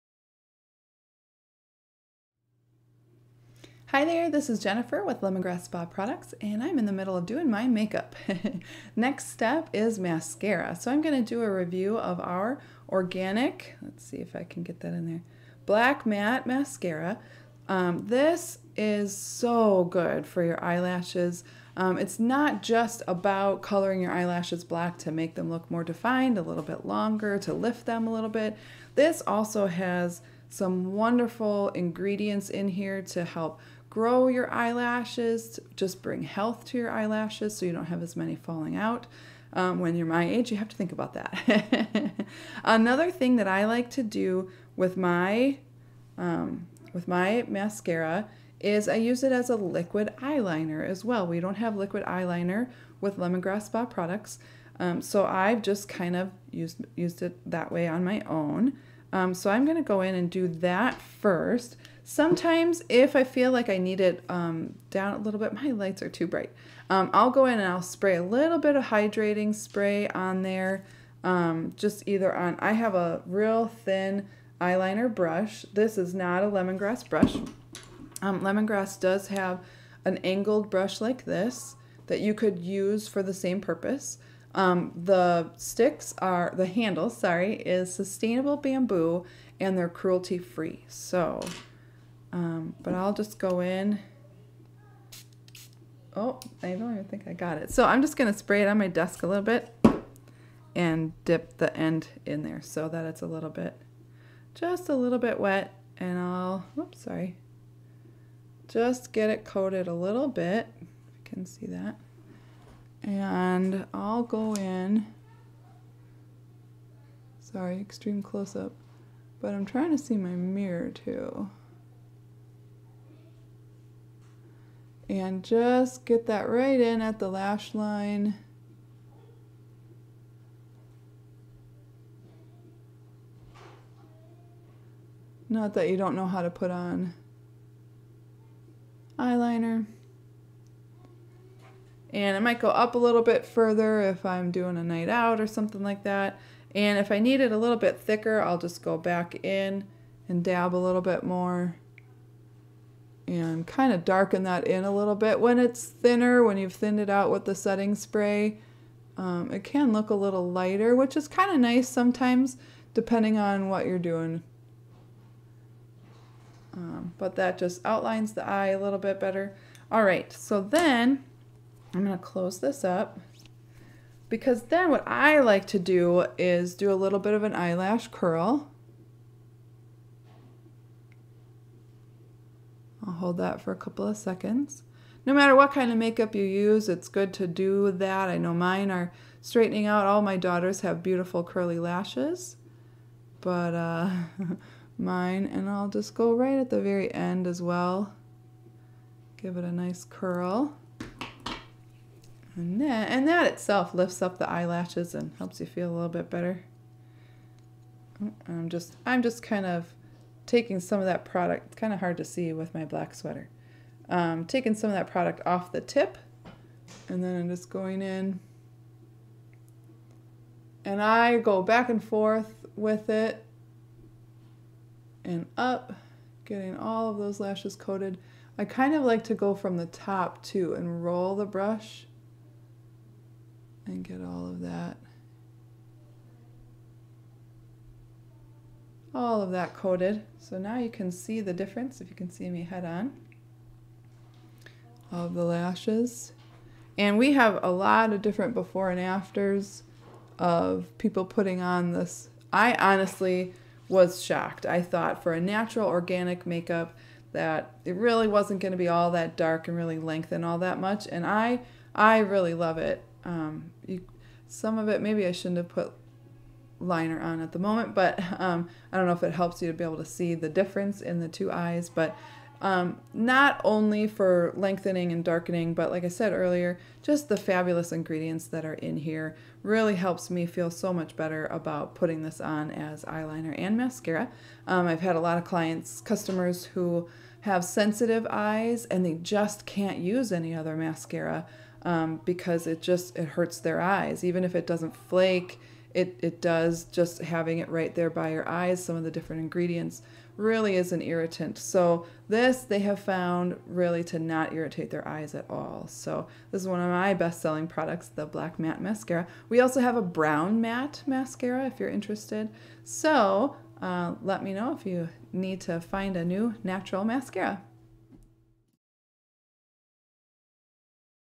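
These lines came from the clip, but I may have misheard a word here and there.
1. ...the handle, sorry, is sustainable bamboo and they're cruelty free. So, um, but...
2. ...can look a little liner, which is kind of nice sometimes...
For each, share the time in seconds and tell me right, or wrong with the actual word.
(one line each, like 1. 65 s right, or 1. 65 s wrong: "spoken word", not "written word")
1. 86 s right
2. 159 s wrong: "lighter", not "liner".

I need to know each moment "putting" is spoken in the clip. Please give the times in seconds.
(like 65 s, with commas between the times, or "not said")
251 s, 281 s.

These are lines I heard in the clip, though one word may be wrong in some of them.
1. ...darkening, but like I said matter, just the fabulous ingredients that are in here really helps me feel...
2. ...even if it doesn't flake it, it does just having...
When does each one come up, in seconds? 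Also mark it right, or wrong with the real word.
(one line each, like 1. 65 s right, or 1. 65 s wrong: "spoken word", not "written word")
1. 275 s wrong: "earlier", not "matter"
2. 294 s right.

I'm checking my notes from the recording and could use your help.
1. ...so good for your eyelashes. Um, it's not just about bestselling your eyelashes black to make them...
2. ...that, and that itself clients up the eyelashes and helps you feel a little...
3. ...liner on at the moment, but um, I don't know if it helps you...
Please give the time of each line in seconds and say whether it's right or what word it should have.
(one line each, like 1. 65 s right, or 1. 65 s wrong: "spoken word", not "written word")
1. 19 s wrong: "coloring", not "bestselling"
2. 202 s wrong: "lifts", not "clients"
3. 266 s right.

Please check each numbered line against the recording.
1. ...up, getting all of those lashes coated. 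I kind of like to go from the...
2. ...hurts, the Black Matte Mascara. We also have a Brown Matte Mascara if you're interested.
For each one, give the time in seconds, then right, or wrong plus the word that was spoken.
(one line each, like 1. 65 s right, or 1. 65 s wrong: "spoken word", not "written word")
1. 225 s right
2. 307 s wrong: "products", not "hurts".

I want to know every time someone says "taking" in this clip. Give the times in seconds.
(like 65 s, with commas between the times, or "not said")
210 s, 214 s.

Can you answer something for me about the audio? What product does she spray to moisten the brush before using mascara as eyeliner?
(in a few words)
hydrating spray.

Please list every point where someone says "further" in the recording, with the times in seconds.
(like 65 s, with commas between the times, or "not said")
143 s.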